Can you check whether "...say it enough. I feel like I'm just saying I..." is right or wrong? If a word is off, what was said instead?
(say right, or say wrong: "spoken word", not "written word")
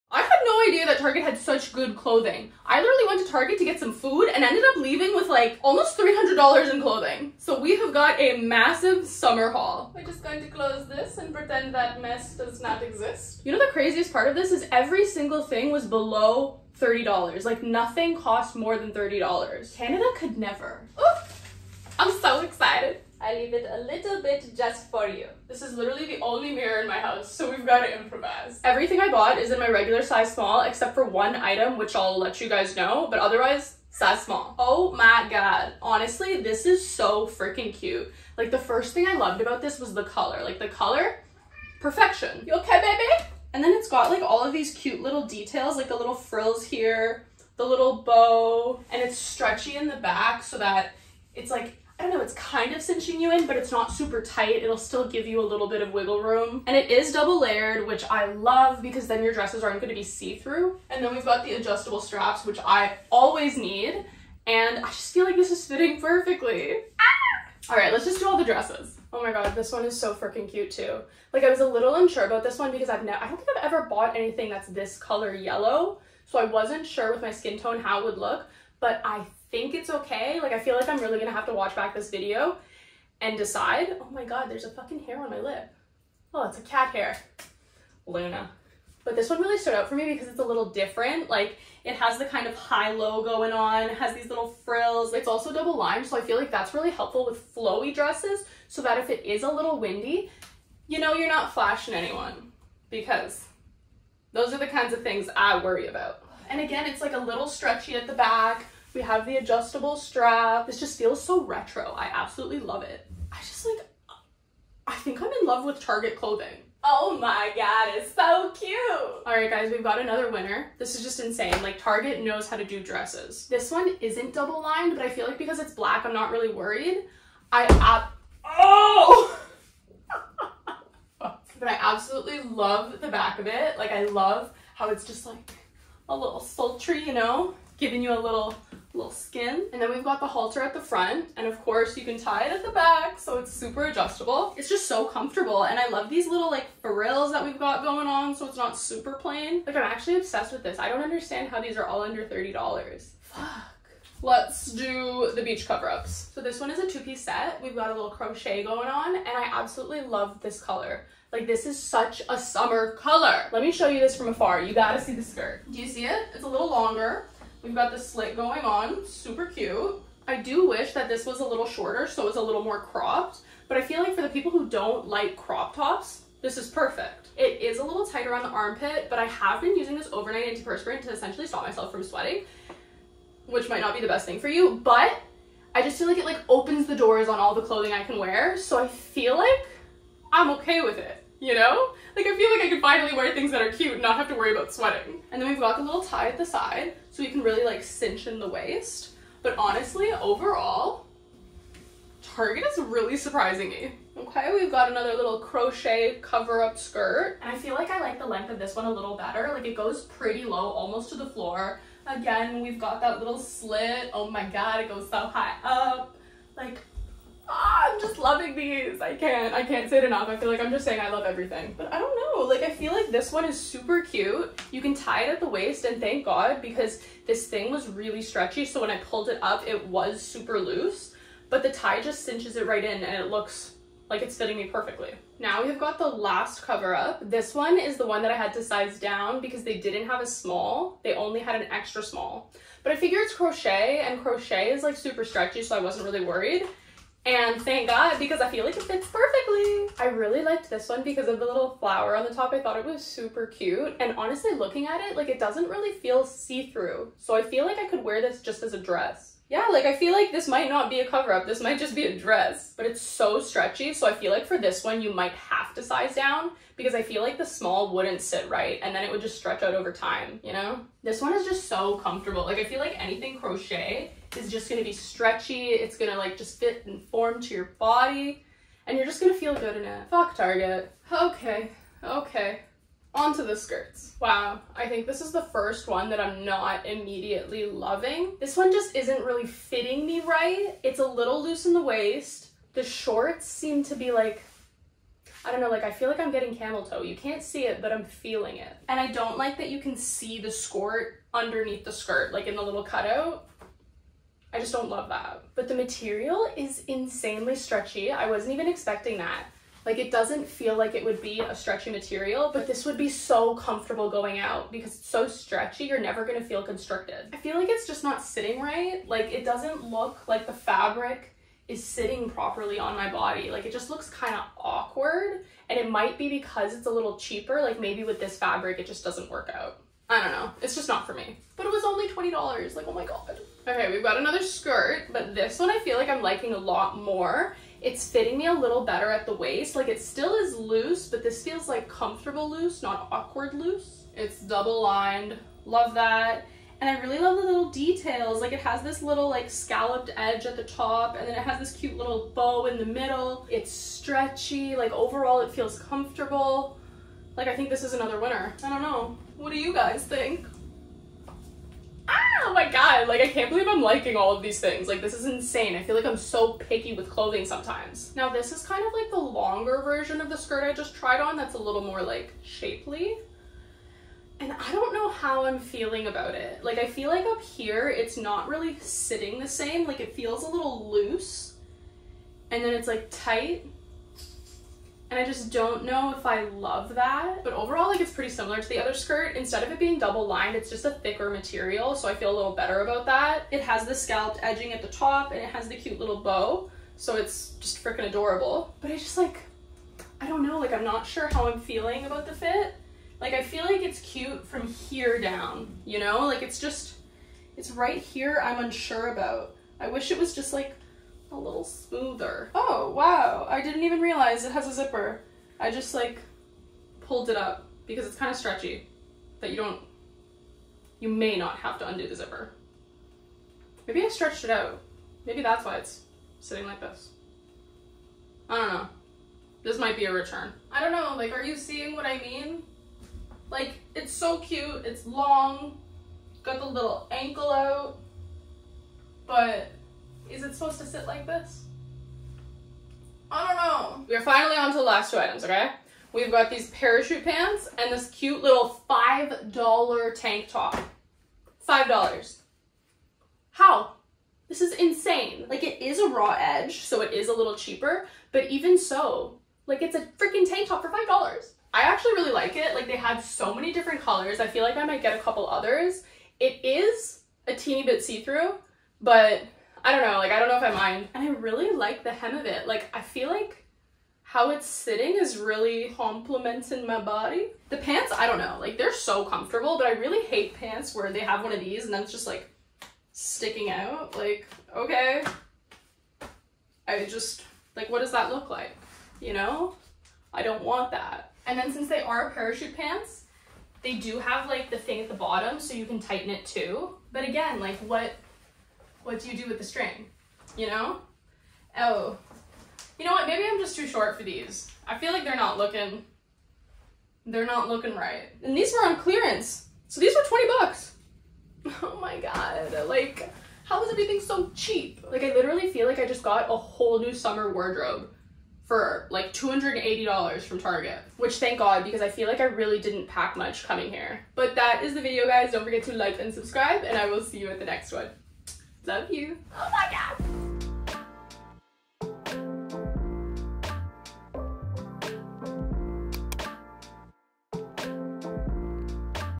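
right.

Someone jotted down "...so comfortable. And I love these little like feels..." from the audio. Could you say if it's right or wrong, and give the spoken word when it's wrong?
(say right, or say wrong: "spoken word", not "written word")
wrong: "frills", not "feels".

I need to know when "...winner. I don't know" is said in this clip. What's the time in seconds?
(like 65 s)
358 s.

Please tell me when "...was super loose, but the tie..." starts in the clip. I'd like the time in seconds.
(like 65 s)
229 s.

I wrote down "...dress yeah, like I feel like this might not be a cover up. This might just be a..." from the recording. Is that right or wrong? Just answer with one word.
right.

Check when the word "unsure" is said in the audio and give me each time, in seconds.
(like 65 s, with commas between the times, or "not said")
71 s, 408 s.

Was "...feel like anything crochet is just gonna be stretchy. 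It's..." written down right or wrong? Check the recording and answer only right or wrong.
right.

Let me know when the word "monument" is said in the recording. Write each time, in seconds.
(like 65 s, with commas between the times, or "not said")
not said.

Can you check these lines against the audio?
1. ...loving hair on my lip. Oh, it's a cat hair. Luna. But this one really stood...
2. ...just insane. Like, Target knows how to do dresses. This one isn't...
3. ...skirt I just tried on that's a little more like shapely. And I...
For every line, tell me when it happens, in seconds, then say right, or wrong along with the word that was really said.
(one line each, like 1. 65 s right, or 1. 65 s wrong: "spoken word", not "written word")
1. 84 s wrong: "fucking", not "loving"
2. 121 s right
3. 370 s right.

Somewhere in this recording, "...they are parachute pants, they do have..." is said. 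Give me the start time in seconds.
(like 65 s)
491 s.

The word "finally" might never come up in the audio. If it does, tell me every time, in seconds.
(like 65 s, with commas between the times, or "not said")
192 s, 444 s.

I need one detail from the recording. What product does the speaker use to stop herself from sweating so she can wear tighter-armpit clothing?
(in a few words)
overnight antiperspirant.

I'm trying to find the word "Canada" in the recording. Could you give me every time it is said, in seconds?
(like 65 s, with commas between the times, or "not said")
19 s.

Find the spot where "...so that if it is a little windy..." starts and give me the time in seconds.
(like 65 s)
98 s.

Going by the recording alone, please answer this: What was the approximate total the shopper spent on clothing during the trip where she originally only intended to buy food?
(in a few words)
almost $300.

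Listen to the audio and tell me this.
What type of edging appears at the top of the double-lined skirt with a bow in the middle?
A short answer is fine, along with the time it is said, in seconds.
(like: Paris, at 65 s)
scalloped edge, at 349 s.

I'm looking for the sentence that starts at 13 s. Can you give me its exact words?
You know the craziest part of this is every single thing was below $30.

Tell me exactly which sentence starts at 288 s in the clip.
This one just isn't really fitting me right.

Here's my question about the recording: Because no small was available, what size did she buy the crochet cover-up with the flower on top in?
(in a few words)
extra small.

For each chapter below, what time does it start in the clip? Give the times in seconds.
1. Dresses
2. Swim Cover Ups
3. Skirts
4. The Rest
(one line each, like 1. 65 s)
1. 25 s
2. 156 s
3. 284 s
4. 444 s.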